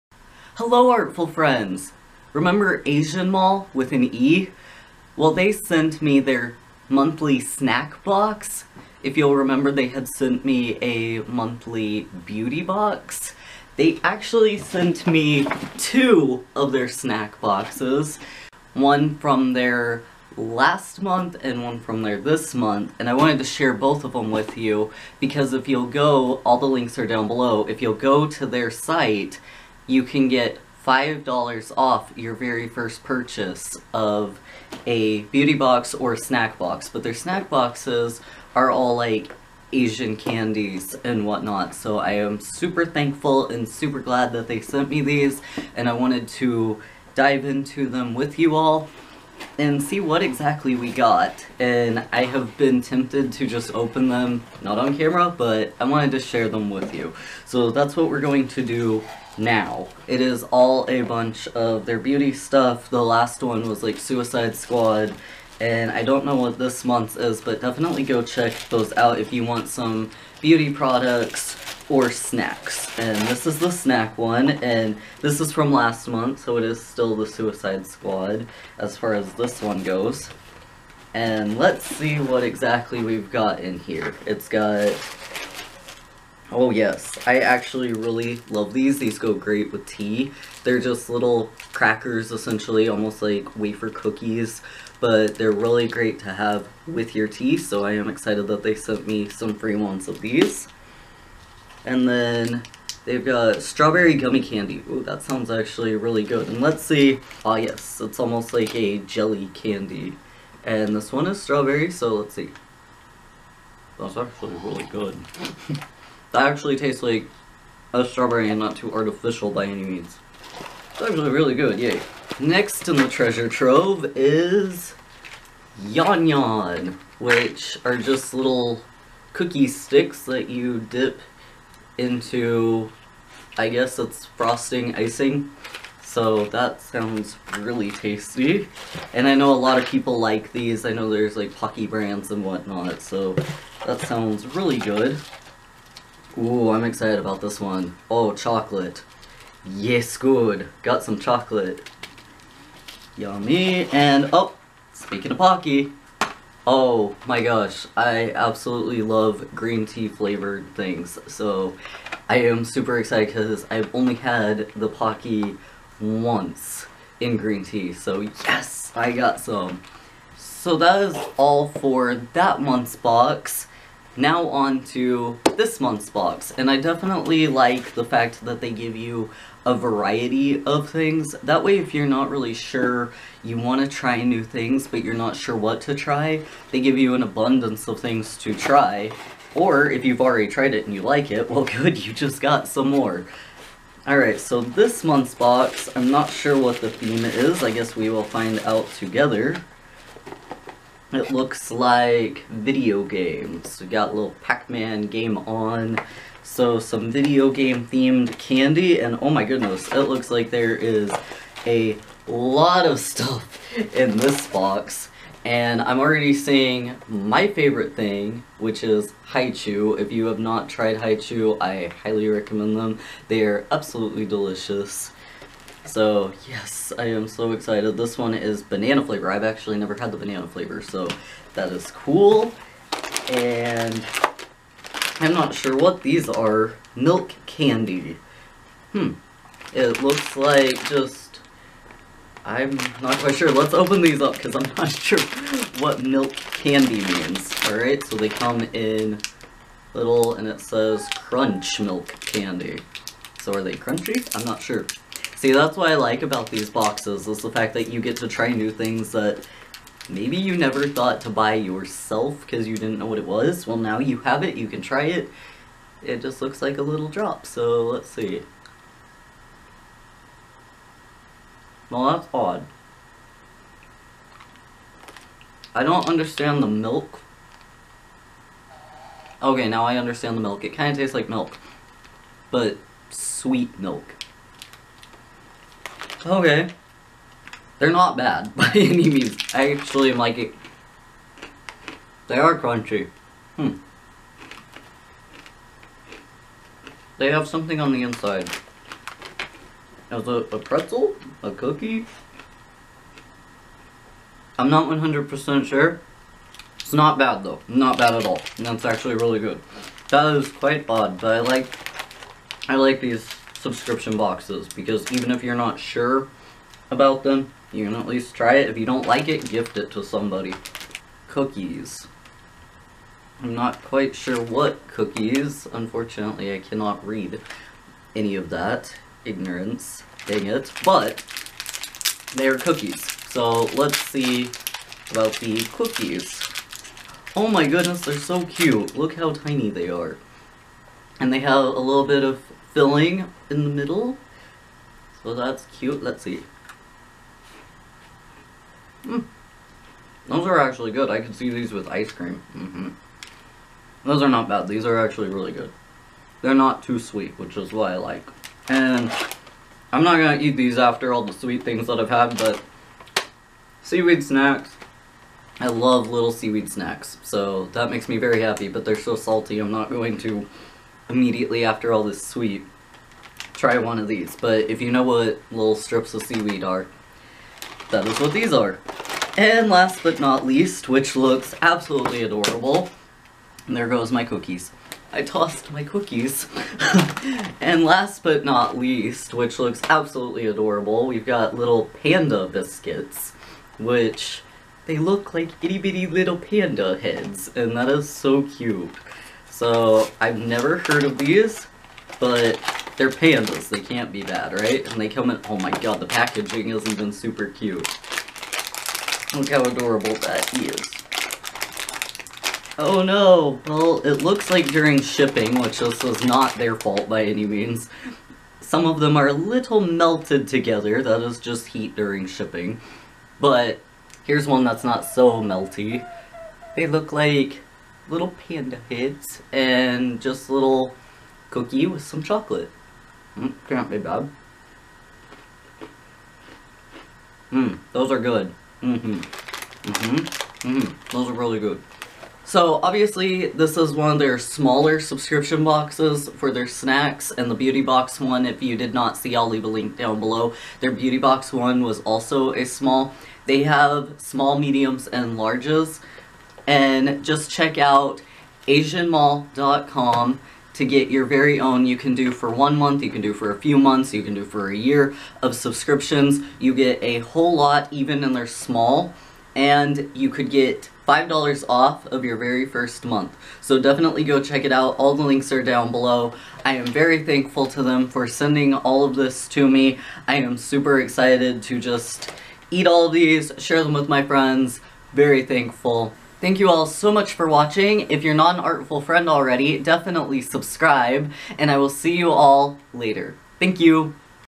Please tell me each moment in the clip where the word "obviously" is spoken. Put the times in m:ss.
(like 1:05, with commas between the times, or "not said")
7:22.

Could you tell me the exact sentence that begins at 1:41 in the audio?
And then they've got strawberry gummy candy.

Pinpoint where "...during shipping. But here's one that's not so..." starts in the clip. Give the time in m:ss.
7:01.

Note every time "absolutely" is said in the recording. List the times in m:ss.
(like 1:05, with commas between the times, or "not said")
2:38, 3:43, 6:21, 6:29.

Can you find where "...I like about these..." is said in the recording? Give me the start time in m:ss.
4:15.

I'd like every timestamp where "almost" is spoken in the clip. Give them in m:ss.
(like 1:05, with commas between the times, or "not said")
1:32, 1:48.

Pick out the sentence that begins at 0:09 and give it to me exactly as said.
If you'll remember, they had sent me a monthly beauty box.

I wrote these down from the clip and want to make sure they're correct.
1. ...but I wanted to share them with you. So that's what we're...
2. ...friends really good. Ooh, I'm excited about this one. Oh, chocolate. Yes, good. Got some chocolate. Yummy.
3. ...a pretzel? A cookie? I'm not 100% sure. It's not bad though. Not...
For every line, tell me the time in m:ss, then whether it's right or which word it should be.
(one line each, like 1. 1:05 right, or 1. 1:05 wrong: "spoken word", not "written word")
1. 0:55 right
2. 2:23 wrong: "sounds", not "friends"
3. 5:00 right.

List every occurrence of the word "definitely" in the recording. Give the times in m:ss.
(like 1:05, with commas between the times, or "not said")
1:07, 2:56, 7:53, 8:09.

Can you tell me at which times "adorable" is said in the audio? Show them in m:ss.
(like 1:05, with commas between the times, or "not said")
6:22, 6:30, 6:49.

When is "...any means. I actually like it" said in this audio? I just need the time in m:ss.
4:48.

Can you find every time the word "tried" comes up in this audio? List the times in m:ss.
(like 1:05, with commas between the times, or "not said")
3:10, 3:40.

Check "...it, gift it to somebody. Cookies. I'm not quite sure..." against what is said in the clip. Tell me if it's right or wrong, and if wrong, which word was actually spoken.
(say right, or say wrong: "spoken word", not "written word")
right.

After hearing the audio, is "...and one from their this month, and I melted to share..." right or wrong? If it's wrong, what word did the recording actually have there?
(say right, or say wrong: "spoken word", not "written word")
wrong: "wanted", not "melted".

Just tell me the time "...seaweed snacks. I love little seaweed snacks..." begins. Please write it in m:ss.
6:03.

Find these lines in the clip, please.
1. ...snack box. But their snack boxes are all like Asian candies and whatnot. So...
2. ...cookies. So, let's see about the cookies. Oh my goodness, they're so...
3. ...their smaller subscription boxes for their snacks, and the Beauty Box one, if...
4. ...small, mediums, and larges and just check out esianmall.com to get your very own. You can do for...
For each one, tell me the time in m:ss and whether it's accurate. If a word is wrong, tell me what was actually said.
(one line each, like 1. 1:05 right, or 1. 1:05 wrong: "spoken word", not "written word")
1. 0:36 right
2. 5:32 right
3. 7:24 right
4. 7:34 right.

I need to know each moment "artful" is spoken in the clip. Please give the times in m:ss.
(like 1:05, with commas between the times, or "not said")
0:00, 8:08.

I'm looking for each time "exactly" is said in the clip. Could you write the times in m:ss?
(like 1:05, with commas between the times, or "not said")
0:50, 1:22.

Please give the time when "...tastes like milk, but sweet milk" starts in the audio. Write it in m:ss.
4:40.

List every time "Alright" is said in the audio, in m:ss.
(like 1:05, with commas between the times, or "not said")
3:14, 4:07.